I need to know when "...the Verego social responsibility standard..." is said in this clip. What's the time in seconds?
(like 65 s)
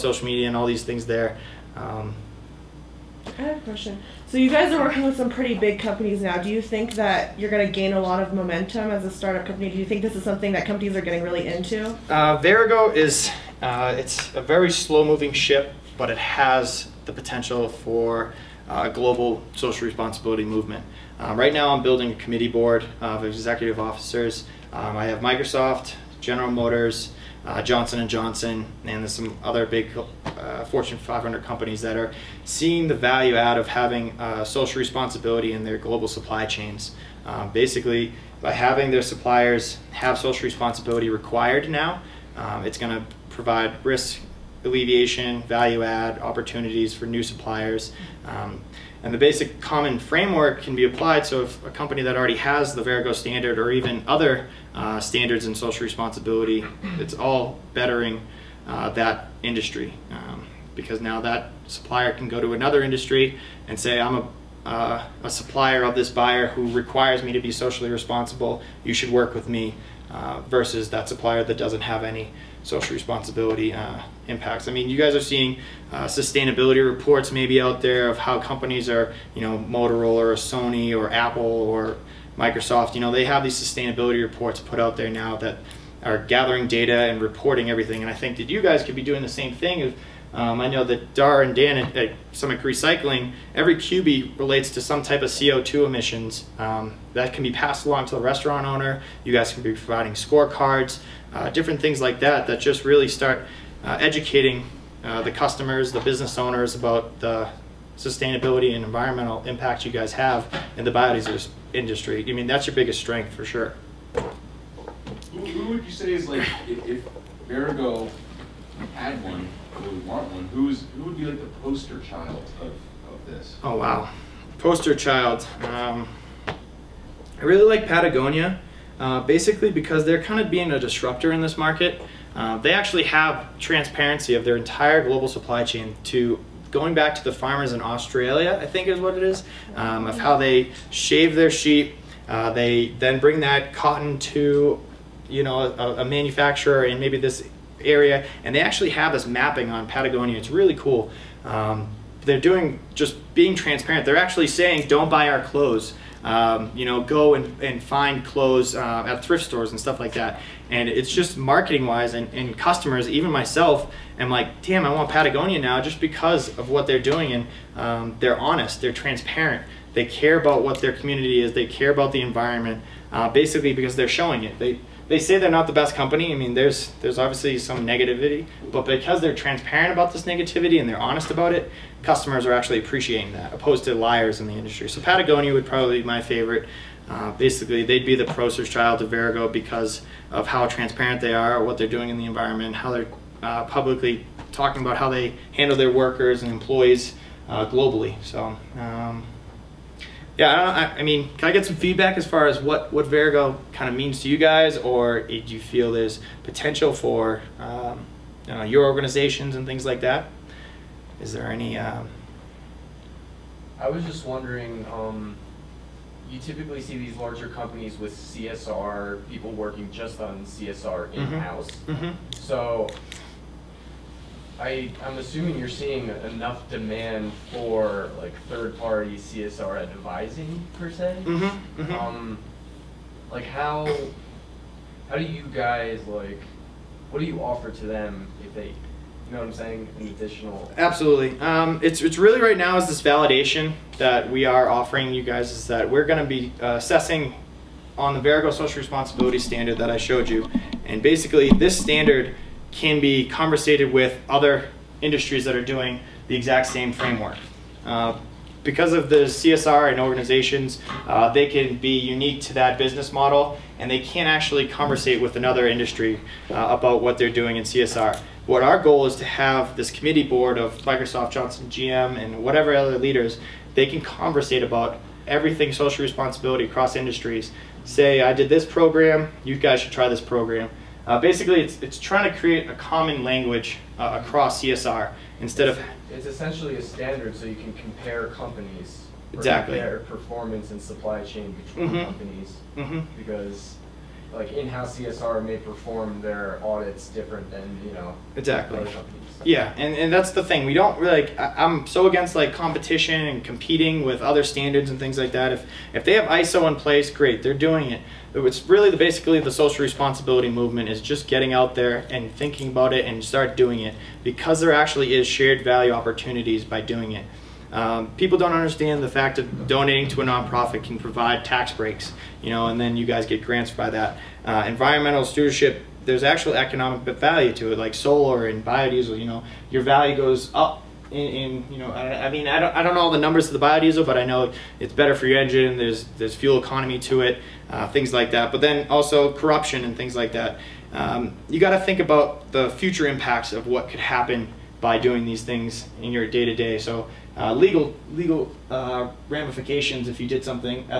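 248 s.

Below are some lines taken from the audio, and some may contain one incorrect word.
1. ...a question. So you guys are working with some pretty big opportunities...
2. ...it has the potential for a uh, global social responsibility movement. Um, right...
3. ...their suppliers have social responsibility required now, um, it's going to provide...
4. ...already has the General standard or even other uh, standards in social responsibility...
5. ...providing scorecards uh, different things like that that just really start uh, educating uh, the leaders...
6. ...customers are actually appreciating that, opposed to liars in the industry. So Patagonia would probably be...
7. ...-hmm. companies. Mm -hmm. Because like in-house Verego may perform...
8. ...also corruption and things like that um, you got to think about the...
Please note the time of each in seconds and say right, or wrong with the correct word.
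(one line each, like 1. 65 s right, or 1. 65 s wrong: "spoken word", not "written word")
1. 3 s wrong: "companies", not "opportunities"
2. 16 s right
3. 38 s right
4. 52 s wrong: "Verego", not "General"
5. 99 s wrong: "customers", not "leaders"
6. 182 s right
7. 291 s wrong: "CSR", not "Verego"
8. 338 s right.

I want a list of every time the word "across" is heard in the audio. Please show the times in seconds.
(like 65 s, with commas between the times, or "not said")
276 s, 284 s.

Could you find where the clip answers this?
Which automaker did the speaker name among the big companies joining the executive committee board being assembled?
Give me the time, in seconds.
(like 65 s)
26 s.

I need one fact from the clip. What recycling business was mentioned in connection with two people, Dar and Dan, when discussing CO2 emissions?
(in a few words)
Summit Recycling.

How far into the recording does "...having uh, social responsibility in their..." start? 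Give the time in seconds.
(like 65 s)
33 s.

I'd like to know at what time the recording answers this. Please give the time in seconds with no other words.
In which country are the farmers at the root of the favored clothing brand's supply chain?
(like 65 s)
137 s.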